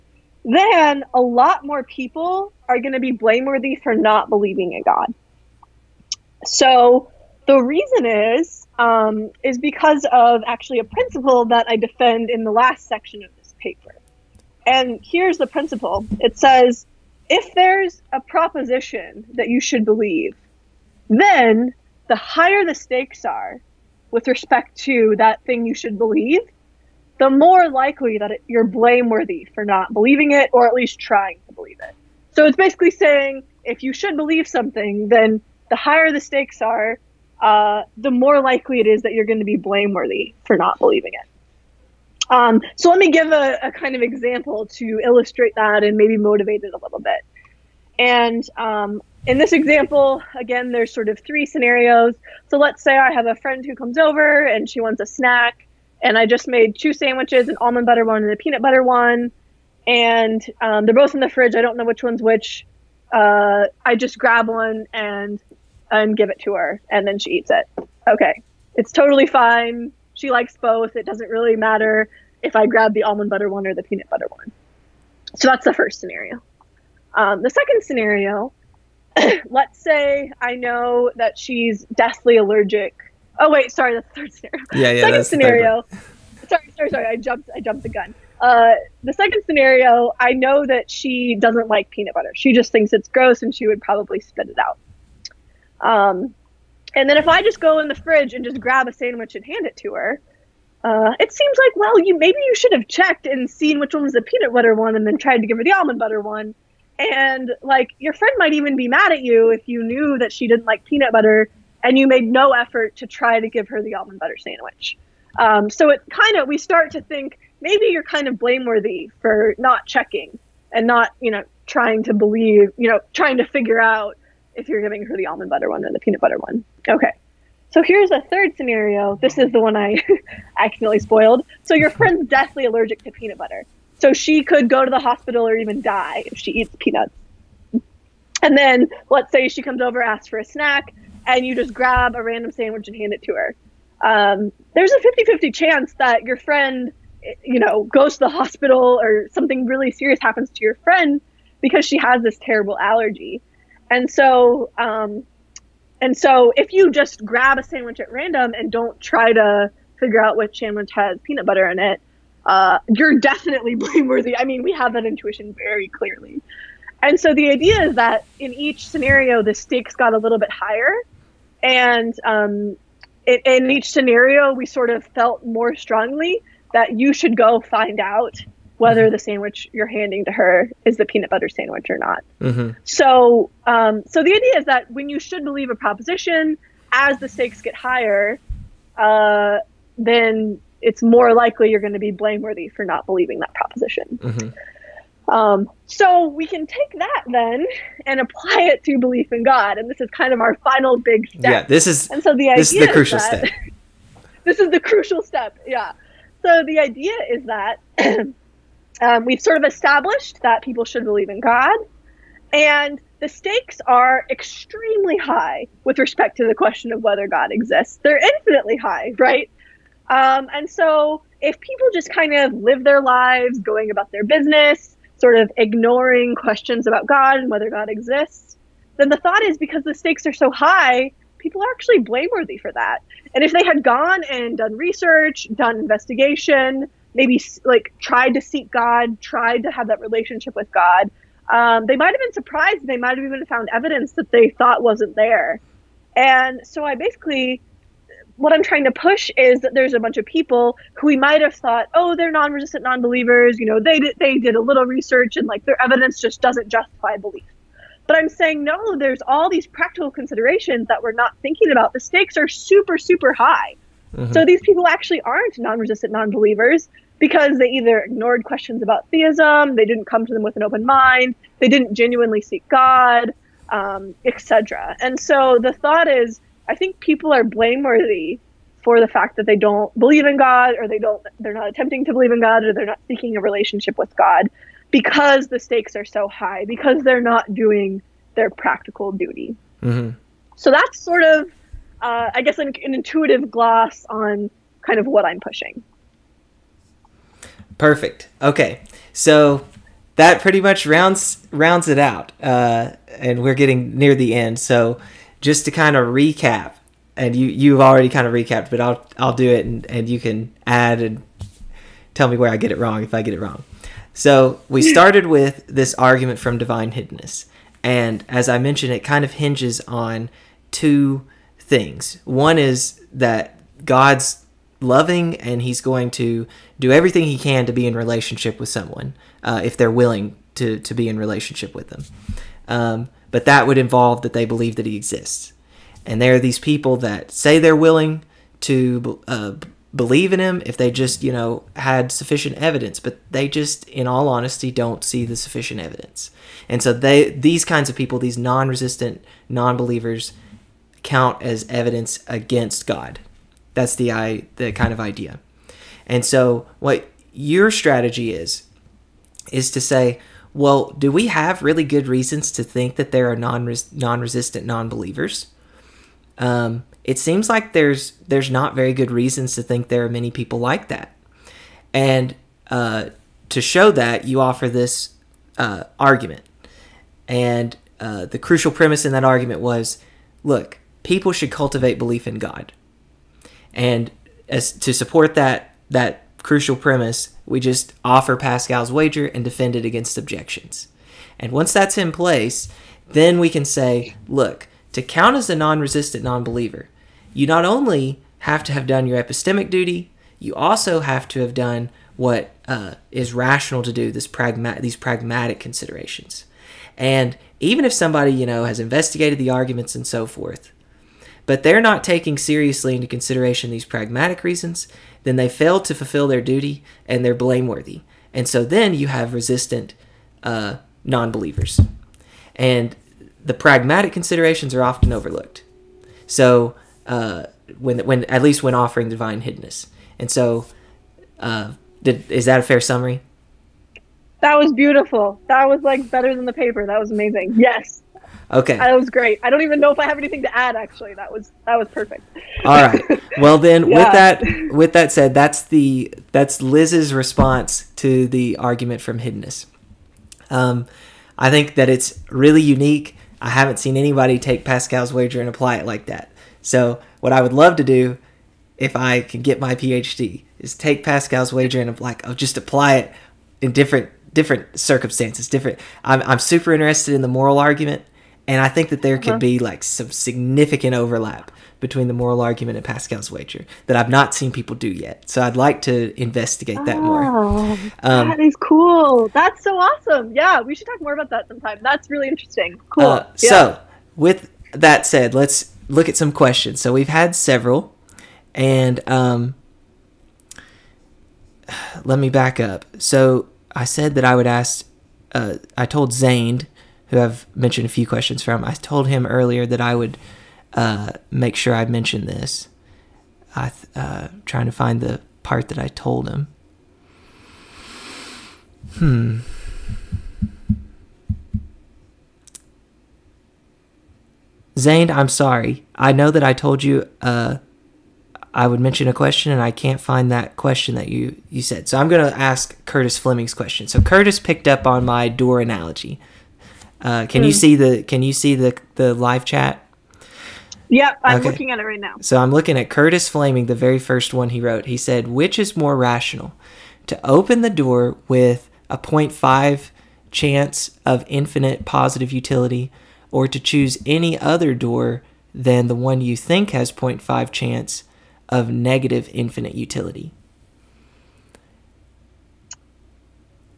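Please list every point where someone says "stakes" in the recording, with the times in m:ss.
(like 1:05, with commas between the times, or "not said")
0:22, 0:36, 2:49, 3:07, 3:33, 3:49, 4:21, 4:45.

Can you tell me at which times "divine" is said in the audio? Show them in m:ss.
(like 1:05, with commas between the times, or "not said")
5:16, 7:09.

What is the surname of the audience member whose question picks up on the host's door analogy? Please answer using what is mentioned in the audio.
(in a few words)
Fleming.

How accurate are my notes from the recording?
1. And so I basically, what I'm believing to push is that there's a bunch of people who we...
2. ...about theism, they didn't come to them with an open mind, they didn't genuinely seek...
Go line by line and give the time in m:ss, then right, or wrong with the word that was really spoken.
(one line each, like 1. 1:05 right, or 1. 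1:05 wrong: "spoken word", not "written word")
1. 4:06 wrong: "trying", not "believing"
2. 4:28 right.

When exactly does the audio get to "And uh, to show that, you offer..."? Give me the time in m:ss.
6:11.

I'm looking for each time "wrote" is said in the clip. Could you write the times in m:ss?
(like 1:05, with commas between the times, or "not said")
8:54.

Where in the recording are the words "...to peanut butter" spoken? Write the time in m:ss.
2:13.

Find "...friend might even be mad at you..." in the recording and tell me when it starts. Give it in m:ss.
1:48.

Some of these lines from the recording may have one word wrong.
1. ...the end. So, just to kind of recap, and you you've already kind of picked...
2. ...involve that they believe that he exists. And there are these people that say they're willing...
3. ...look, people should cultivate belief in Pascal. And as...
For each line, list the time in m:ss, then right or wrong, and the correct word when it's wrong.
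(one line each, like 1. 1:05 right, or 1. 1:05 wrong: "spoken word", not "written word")
1. 5:04 wrong: "recapped", not "picked"
2. 5:33 right
3. 6:20 wrong: "God", not "Pascal".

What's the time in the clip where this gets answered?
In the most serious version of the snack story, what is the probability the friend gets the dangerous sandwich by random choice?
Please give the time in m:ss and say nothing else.
2:24.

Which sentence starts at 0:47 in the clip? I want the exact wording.
And um, in this example, again, there's sort of three scenarios.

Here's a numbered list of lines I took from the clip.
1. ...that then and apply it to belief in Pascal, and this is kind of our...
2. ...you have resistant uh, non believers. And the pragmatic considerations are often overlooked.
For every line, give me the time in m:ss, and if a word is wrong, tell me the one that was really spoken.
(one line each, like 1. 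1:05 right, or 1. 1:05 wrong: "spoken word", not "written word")
1. 3:16 wrong: "God", not "Pascal"
2. 6:58 right.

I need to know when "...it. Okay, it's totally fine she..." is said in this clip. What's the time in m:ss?
1:07.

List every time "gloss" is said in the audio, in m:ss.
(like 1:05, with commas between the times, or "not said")
4:53.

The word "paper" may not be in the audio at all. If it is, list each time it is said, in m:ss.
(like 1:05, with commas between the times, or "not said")
0:13, 7:16.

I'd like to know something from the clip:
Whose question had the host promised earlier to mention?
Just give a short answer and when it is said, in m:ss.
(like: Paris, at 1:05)
Zane, at 8:34.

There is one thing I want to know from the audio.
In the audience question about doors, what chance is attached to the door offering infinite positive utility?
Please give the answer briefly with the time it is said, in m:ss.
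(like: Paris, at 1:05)
0.5, at 8:58.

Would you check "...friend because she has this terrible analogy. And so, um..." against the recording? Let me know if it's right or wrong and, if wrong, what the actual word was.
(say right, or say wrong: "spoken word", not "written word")
wrong: "allergy", not "analogy".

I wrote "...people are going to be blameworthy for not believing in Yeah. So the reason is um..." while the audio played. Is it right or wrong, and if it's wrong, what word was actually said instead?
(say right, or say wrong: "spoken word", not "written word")
wrong: "God", not "Yeah".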